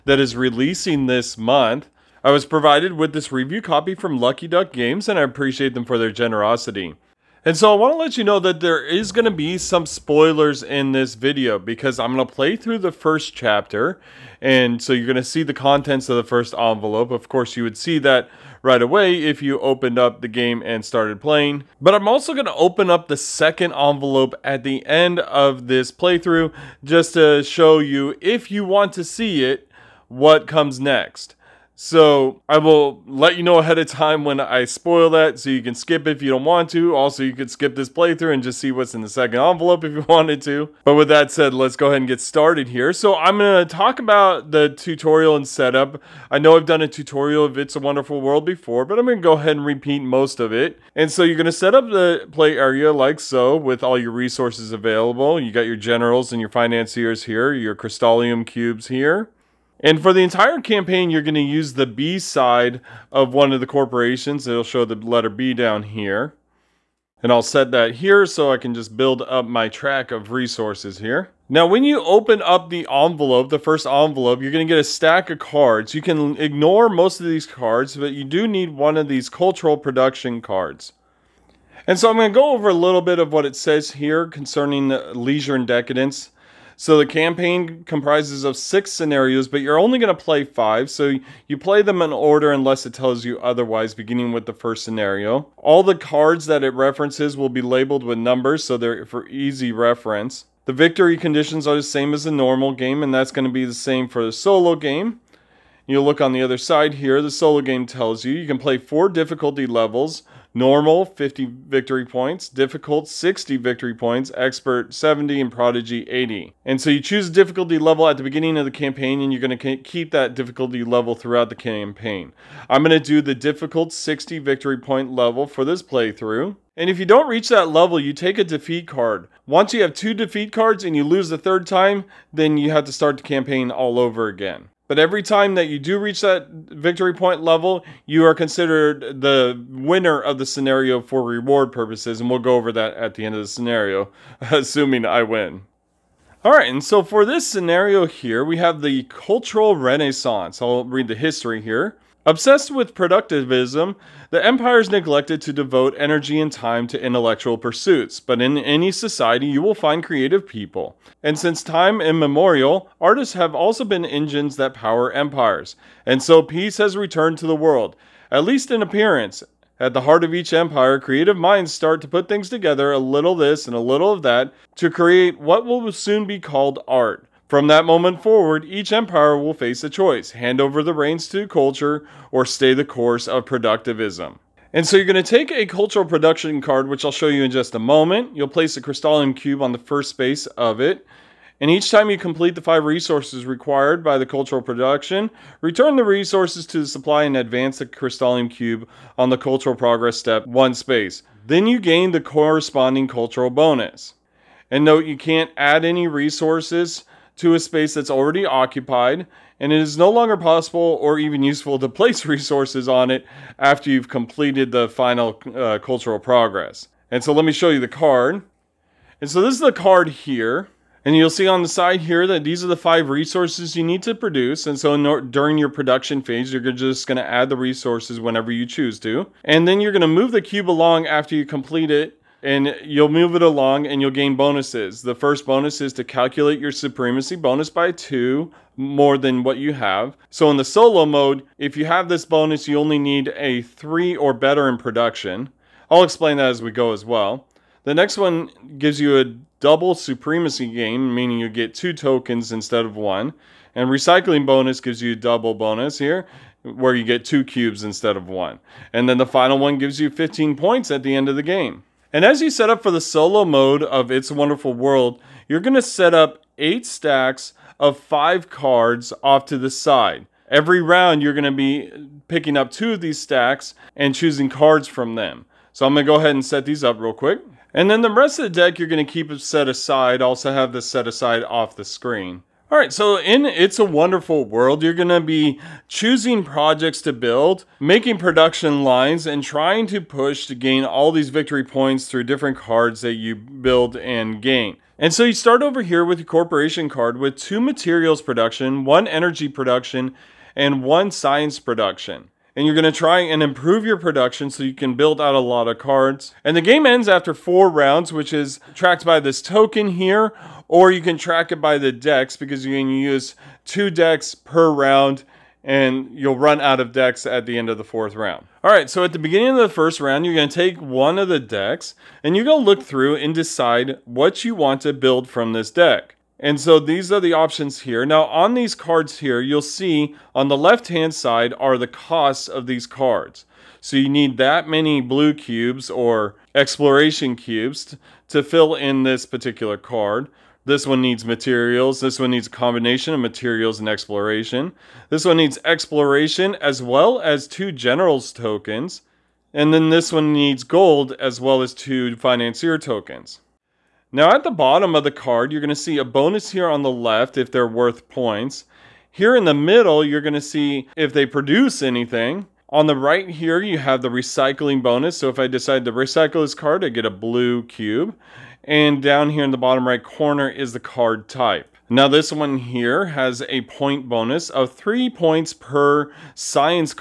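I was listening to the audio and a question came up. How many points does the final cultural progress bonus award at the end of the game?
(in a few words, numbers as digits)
15.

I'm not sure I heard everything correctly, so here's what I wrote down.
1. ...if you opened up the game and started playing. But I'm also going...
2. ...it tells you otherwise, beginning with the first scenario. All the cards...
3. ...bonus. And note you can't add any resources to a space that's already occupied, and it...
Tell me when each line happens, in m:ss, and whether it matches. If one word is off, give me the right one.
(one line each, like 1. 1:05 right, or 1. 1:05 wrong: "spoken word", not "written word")
1. 0:19 right
2. 1:32 right
3. 3:23 right.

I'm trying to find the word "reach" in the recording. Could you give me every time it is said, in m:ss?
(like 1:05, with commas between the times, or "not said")
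2:07, 2:15.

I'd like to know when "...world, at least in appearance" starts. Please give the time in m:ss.
2:47.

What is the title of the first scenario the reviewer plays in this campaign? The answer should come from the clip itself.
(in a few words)
Cultural Renaissance.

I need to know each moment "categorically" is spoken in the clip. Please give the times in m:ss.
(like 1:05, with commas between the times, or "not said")
not said.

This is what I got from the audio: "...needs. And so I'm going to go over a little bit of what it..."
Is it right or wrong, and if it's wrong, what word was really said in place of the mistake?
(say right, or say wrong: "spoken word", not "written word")
wrong: "cards", not "needs".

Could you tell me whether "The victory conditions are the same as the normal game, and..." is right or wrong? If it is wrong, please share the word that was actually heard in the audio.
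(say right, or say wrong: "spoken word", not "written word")
right.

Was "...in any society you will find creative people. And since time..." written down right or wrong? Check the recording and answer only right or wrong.
right.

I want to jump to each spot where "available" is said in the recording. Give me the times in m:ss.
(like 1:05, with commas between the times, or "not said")
0:54.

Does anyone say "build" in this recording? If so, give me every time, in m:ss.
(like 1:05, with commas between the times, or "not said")
1:08, 4:47, 4:53, 5:04, 5:24.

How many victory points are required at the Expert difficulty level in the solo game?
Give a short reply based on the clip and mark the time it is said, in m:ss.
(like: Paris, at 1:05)
70, at 1:54.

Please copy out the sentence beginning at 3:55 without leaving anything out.
The first bonus is to calculate your supremacy bonus by two more than what you have.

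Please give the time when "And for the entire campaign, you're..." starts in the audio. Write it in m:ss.
0:59.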